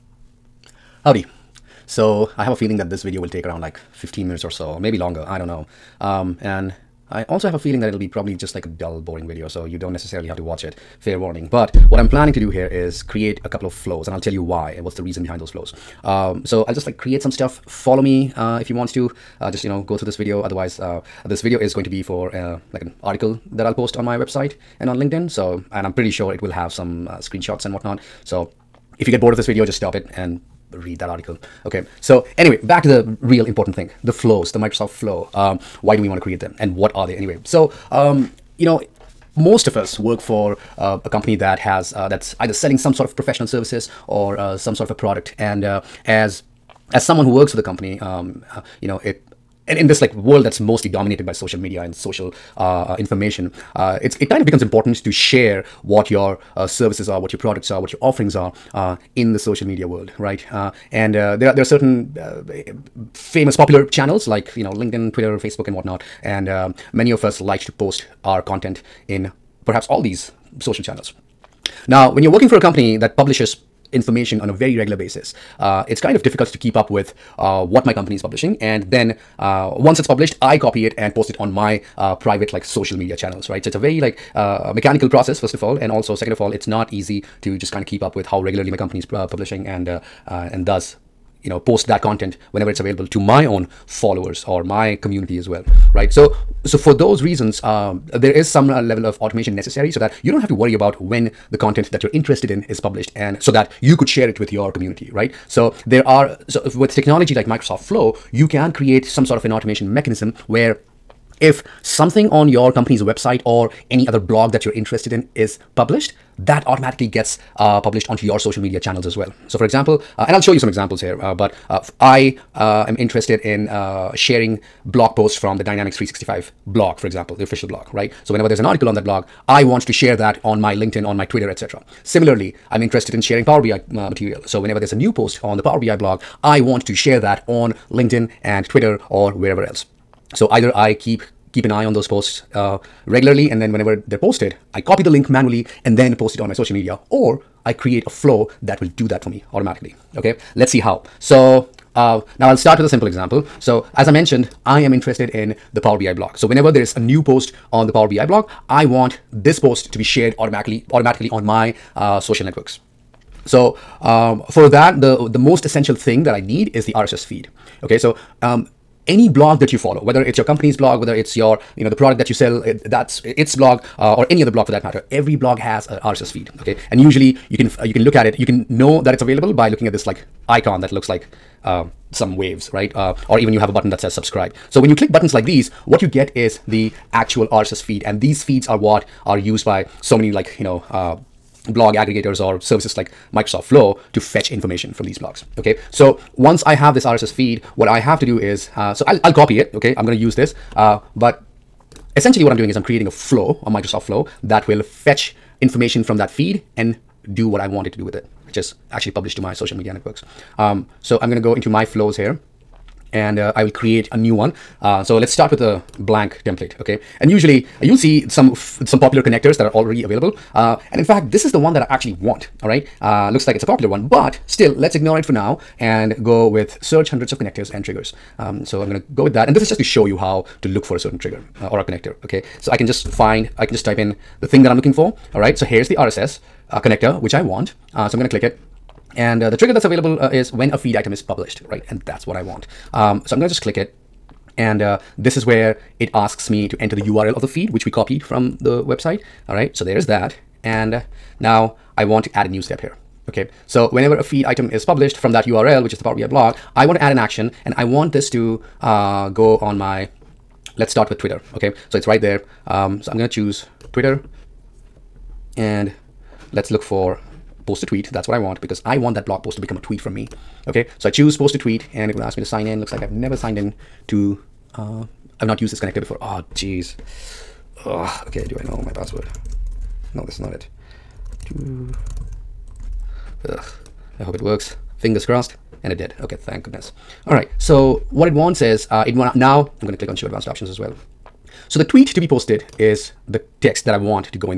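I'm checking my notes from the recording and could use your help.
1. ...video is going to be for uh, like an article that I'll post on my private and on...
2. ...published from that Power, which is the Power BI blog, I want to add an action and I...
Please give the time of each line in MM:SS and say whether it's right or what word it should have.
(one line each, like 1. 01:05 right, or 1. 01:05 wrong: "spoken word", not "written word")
1. 00:21 wrong: "website", not "private"
2. 04:14 wrong: "URL", not "Power".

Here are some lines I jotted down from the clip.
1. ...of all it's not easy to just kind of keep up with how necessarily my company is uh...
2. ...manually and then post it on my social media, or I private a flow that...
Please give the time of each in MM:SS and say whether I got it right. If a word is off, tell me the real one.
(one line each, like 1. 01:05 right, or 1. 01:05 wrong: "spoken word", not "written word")
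1. 01:26 wrong: "regularly", not "necessarily"
2. 02:25 wrong: "create", not "private".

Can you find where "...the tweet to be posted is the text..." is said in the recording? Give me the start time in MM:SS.
04:51.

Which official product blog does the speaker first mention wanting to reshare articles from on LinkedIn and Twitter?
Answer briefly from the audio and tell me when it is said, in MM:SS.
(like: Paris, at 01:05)
Dynamics 365 blog, at 02:05.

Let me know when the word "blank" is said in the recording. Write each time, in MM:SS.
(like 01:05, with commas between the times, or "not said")
03:35.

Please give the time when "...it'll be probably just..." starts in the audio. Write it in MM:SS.
00:07.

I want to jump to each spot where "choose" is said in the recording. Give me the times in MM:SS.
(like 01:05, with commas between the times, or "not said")
04:23, 04:31.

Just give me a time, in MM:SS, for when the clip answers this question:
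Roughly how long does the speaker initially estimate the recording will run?
00:03.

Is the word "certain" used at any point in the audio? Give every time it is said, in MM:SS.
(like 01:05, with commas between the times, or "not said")
01:01, 03:50.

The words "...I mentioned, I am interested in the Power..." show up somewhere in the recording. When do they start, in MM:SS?
02:34.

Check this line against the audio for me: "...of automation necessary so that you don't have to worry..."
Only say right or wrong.
right.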